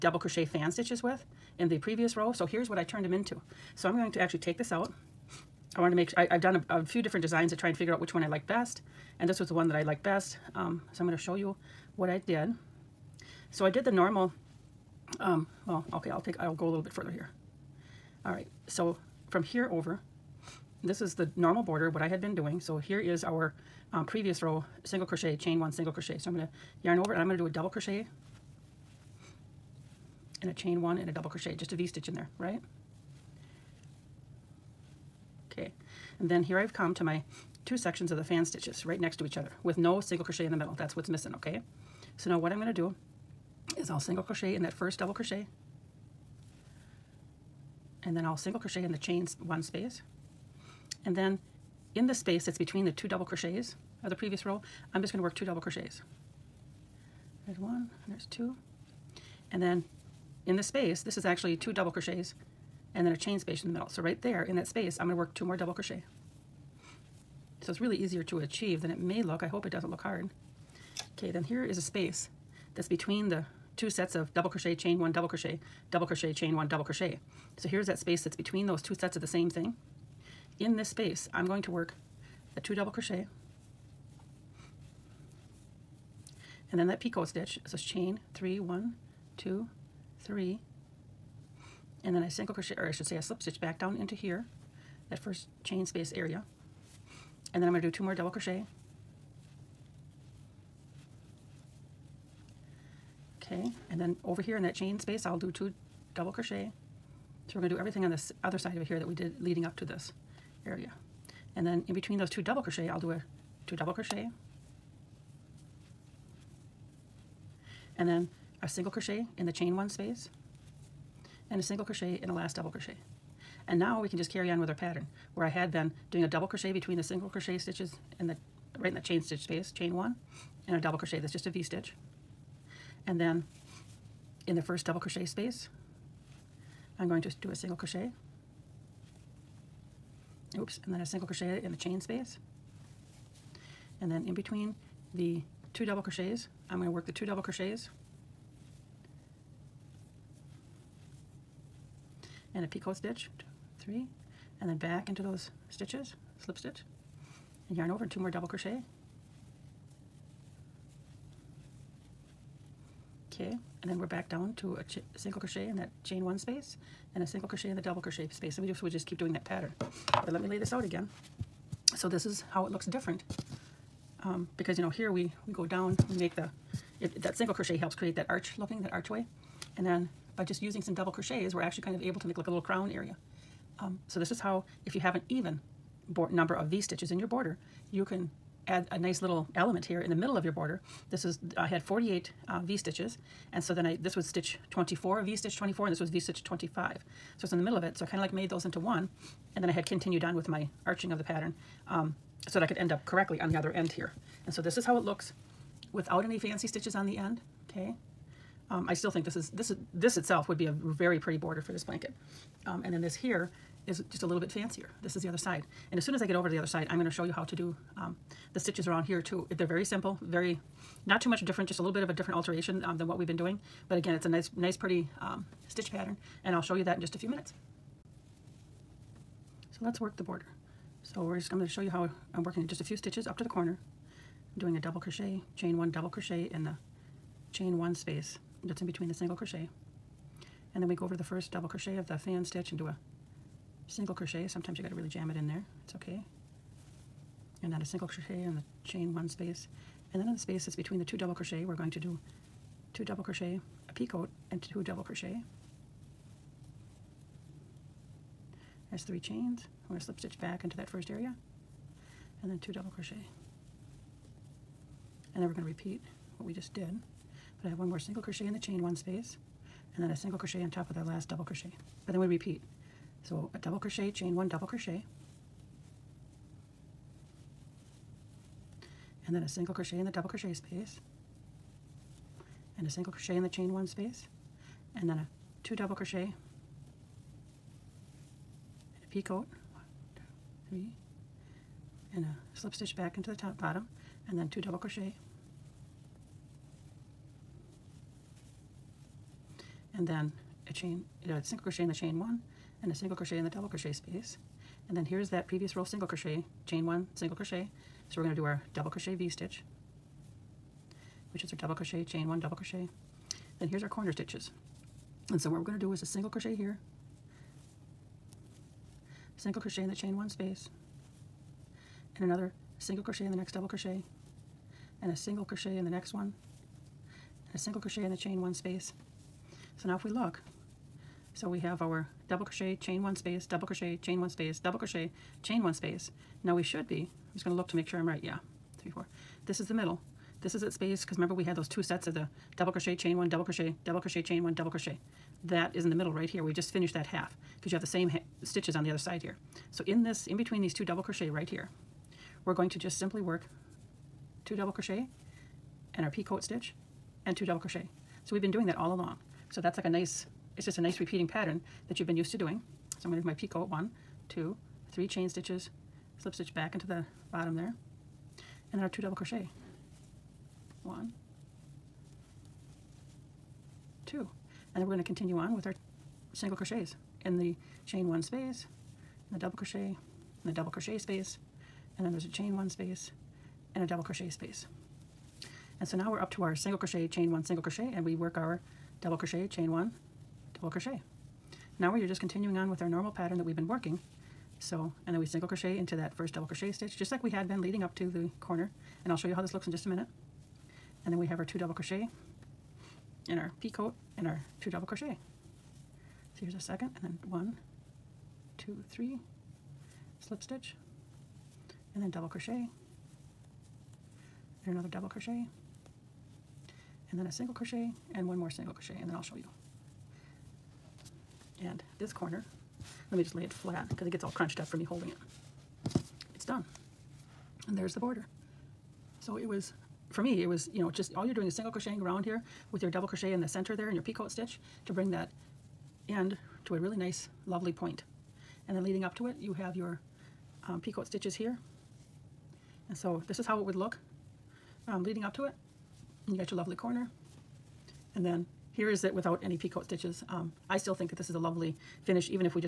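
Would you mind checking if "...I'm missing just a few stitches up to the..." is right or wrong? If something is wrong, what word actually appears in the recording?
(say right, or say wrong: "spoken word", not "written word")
wrong: "working", not "missing".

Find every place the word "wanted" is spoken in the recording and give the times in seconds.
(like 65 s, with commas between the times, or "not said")
5 s.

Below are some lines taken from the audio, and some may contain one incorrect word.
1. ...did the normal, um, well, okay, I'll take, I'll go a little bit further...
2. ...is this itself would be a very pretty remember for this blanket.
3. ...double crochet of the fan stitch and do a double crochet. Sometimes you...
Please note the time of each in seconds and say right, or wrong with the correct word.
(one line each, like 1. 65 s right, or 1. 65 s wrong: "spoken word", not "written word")
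1. 13 s right
2. 209 s wrong: "border", not "remember"
3. 241 s wrong: "single", not "double".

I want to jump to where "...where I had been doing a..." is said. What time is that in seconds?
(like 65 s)
125 s.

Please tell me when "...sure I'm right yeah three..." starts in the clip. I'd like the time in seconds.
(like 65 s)
337 s.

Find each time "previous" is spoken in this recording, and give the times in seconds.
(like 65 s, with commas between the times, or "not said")
1 s, 24 s, 54 s, 305 s.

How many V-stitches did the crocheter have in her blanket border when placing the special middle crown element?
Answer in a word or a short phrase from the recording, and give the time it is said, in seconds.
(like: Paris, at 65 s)
48, at 191 s.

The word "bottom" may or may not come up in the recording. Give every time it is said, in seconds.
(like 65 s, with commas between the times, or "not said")
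293 s, 367 s.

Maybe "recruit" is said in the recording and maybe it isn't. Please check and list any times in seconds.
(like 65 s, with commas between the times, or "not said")
not said.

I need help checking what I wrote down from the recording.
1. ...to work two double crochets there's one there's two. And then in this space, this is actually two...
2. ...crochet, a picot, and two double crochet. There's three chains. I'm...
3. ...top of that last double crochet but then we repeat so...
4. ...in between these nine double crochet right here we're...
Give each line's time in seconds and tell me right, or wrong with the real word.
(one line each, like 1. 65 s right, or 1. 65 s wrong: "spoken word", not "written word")
1. 55 s right
2. 253 s right
3. 270 s right
4. 350 s wrong: "two", not "nine".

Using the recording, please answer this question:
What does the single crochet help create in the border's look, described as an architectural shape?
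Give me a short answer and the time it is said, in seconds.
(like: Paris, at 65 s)
archway, at 178 s.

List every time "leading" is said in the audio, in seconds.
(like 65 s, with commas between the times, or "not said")
109 s, 397 s, 438 s, 445 s.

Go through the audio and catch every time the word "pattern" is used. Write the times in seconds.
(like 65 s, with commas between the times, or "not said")
124 s, 169 s, 201 s, 225 s, 361 s, 393 s.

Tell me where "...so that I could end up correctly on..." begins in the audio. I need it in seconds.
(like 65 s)
202 s.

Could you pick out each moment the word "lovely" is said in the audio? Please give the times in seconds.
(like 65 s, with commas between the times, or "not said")
437 s, 446 s, 451 s.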